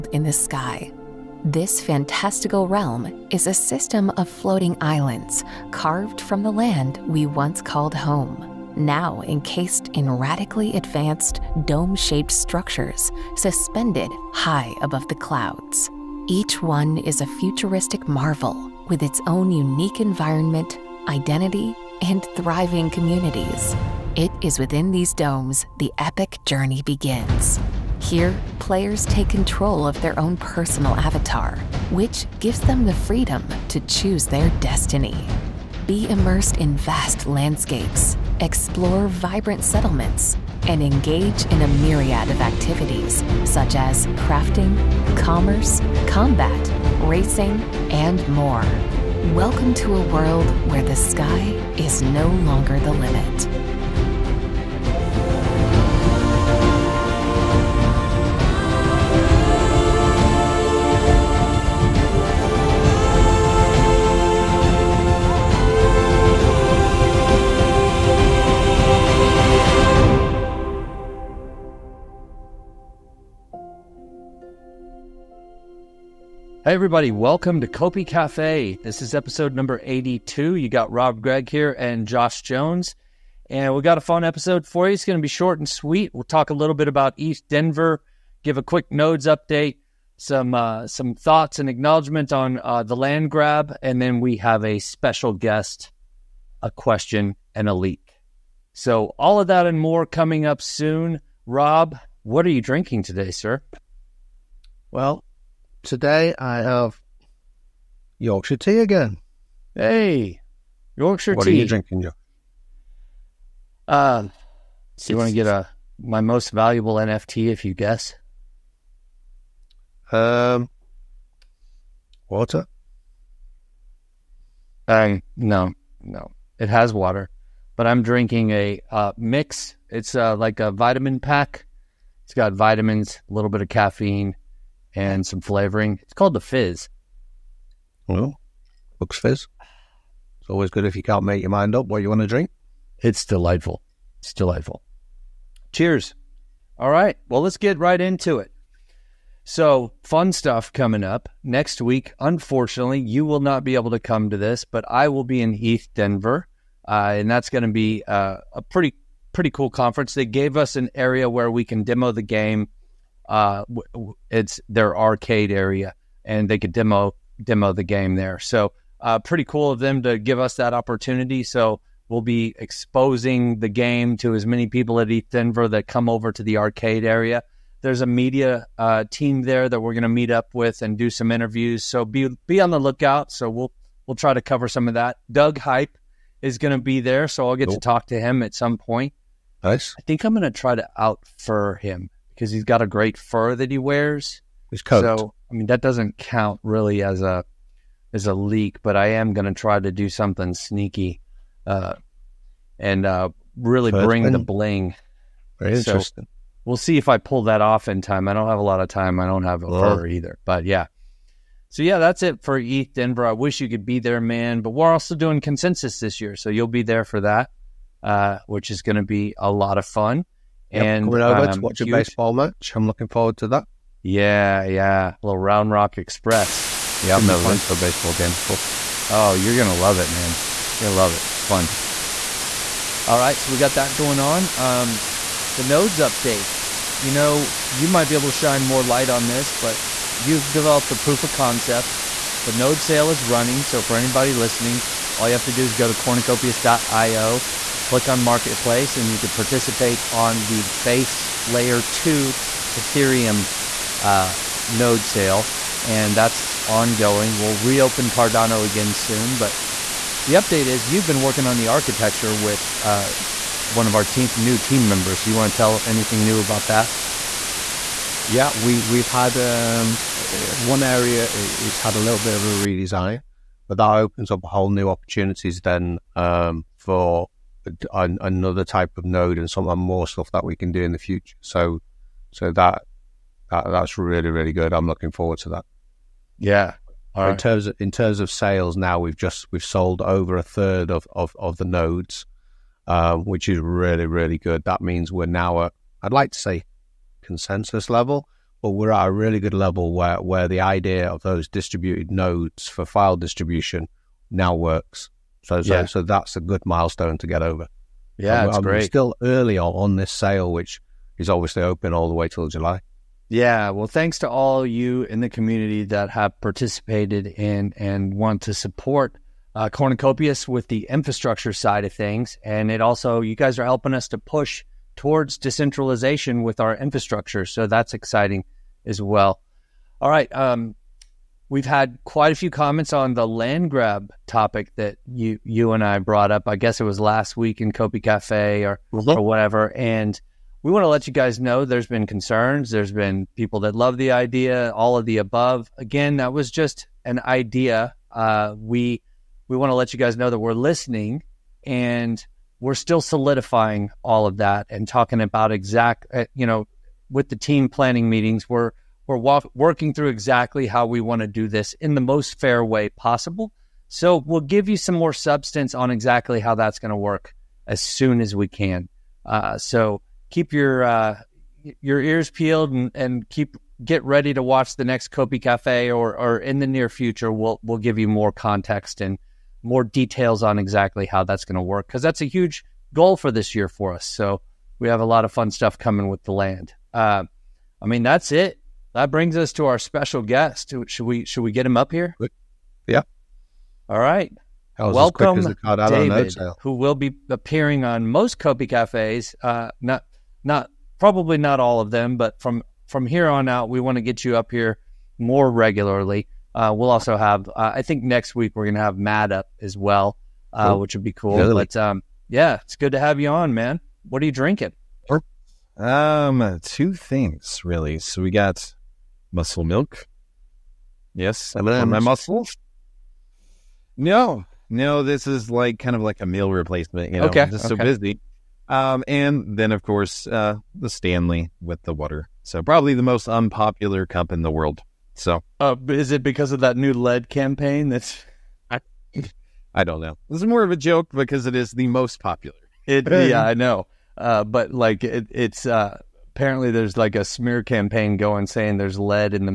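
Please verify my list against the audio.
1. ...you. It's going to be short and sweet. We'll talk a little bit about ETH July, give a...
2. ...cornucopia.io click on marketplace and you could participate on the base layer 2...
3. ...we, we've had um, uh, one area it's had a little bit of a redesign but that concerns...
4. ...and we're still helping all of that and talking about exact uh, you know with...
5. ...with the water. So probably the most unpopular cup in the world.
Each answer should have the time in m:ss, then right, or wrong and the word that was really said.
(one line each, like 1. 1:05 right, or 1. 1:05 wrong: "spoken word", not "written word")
1. 1:24 wrong: "Denver", not "July"
2. 4:05 right
3. 4:28 wrong: "opens", not "concerns"
4. 5:51 wrong: "solidifying", not "helping"
5. 7:11 right.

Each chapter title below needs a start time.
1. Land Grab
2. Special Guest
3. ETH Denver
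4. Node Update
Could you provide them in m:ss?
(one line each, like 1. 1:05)
1. 5:28
2. 6:27
3. 2:26
4. 3:55.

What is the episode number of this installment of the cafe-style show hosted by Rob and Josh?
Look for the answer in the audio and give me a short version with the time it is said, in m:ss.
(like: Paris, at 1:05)
82, at 1:19.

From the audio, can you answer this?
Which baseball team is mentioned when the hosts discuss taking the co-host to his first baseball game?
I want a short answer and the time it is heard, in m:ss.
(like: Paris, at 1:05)
Round Rock Express, at 3:45.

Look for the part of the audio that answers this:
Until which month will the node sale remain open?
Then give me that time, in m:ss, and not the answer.
5:12.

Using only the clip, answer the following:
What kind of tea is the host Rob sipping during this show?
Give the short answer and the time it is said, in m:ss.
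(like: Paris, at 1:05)
Yorkshire tea, at 1:48.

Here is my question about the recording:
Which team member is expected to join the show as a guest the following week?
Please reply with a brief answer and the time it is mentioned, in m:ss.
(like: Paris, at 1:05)
Matt, at 6:48.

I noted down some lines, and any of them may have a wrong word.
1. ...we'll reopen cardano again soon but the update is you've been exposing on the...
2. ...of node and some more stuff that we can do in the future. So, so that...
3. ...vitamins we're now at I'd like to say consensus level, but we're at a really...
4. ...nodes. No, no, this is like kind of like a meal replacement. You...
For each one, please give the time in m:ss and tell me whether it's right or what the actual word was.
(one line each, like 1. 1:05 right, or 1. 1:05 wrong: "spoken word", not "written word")
1. 4:17 wrong: "working", not "exposing"
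2. 4:38 right
3. 4:54 wrong: "means", not "vitamins"
4. 7:01 wrong: "muscles", not "nodes".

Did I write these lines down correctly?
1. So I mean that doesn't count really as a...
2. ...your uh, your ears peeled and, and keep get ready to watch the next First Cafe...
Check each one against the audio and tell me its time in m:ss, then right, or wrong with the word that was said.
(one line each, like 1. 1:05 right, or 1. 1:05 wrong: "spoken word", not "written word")
1. 3:15 right
2. 6:10 wrong: "Copi", not "First".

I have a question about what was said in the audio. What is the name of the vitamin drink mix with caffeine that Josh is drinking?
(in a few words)
the Fizz.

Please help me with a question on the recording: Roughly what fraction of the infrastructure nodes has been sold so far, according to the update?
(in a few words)
over a third.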